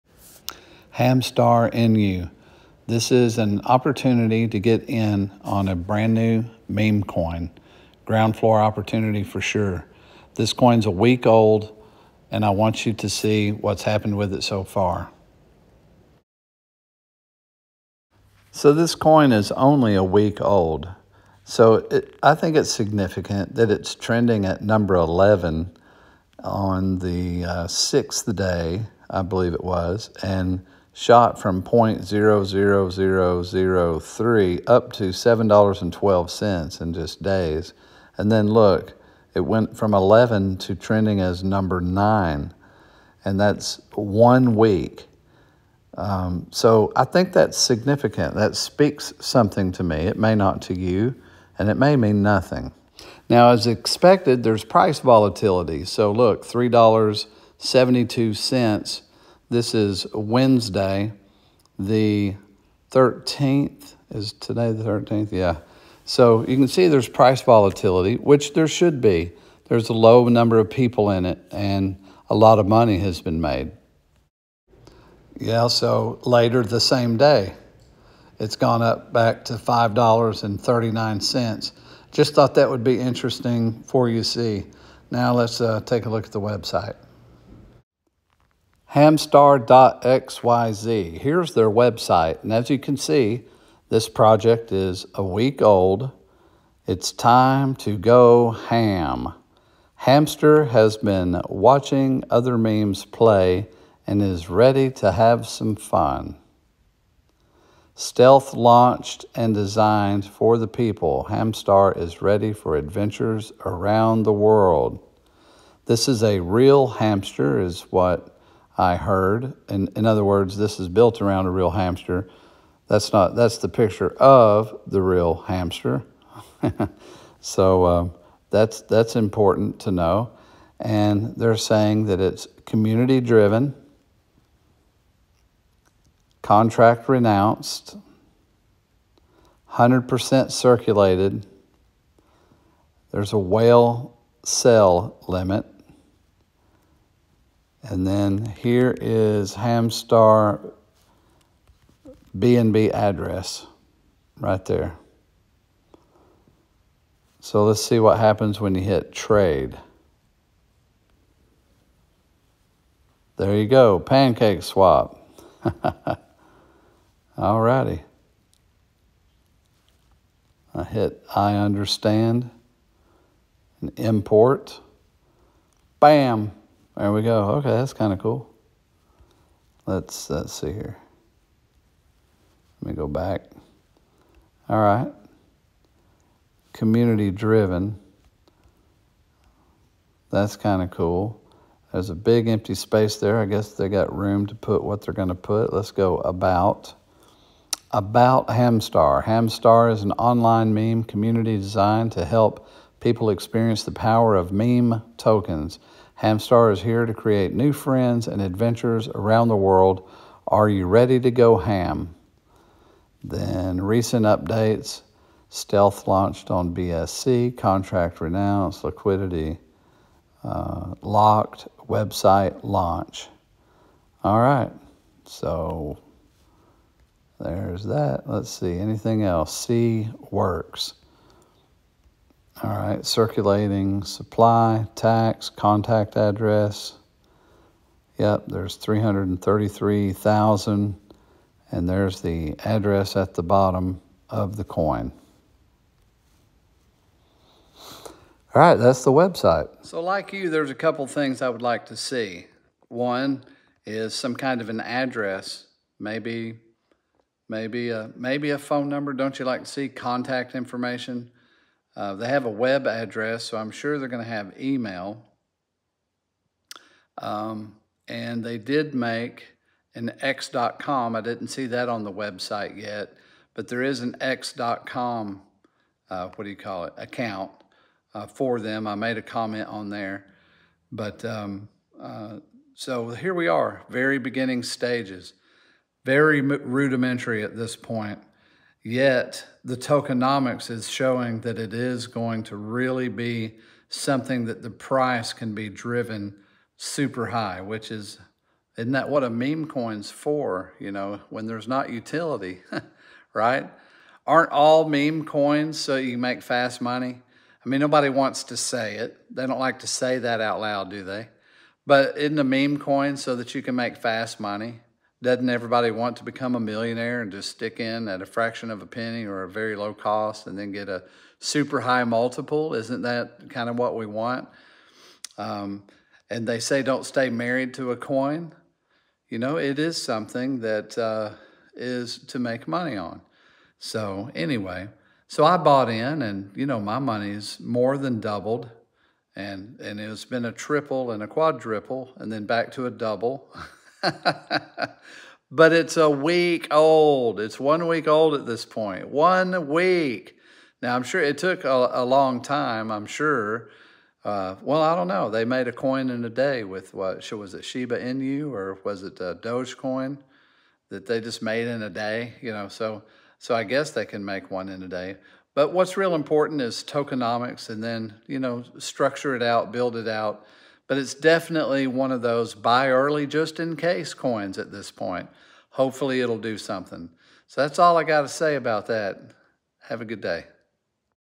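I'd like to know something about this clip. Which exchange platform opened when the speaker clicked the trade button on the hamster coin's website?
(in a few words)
PancakeSwap.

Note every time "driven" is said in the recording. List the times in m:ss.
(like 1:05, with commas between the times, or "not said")
2:13, 3:07, 4:55.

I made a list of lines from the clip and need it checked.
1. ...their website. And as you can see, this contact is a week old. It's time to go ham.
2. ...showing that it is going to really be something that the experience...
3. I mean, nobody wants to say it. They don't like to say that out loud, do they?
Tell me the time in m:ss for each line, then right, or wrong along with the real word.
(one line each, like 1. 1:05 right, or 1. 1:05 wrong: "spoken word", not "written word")
1. 1:31 wrong: "project", not "contact"
2. 4:50 wrong: "price", not "experience"
3. 5:07 right.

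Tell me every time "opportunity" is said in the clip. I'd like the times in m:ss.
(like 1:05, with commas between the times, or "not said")
0:03, 0:08.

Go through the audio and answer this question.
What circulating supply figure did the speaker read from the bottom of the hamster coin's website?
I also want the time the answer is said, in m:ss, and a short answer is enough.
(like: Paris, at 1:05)
333,000, at 3:58.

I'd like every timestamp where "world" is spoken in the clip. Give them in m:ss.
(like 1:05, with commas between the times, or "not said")
1:54, 3:29.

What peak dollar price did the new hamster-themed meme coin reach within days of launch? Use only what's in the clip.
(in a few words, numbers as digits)
$7.12.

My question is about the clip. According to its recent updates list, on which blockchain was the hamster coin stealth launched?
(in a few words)
BSC.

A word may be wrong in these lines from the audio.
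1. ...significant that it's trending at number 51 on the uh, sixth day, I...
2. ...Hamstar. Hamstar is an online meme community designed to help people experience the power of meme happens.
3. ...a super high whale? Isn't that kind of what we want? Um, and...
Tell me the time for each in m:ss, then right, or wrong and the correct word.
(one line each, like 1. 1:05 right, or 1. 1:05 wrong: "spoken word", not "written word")
1. 0:22 wrong: "11", not "51"
2. 3:18 wrong: "tokens", not "happens"
3. 5:20 wrong: "multiple", not "whale".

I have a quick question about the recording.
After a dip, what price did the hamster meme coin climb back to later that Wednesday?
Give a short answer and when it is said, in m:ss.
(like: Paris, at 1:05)
$5.39, at 1:19.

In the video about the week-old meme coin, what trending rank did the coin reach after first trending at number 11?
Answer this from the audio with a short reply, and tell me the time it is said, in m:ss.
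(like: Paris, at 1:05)
9, at 0:41.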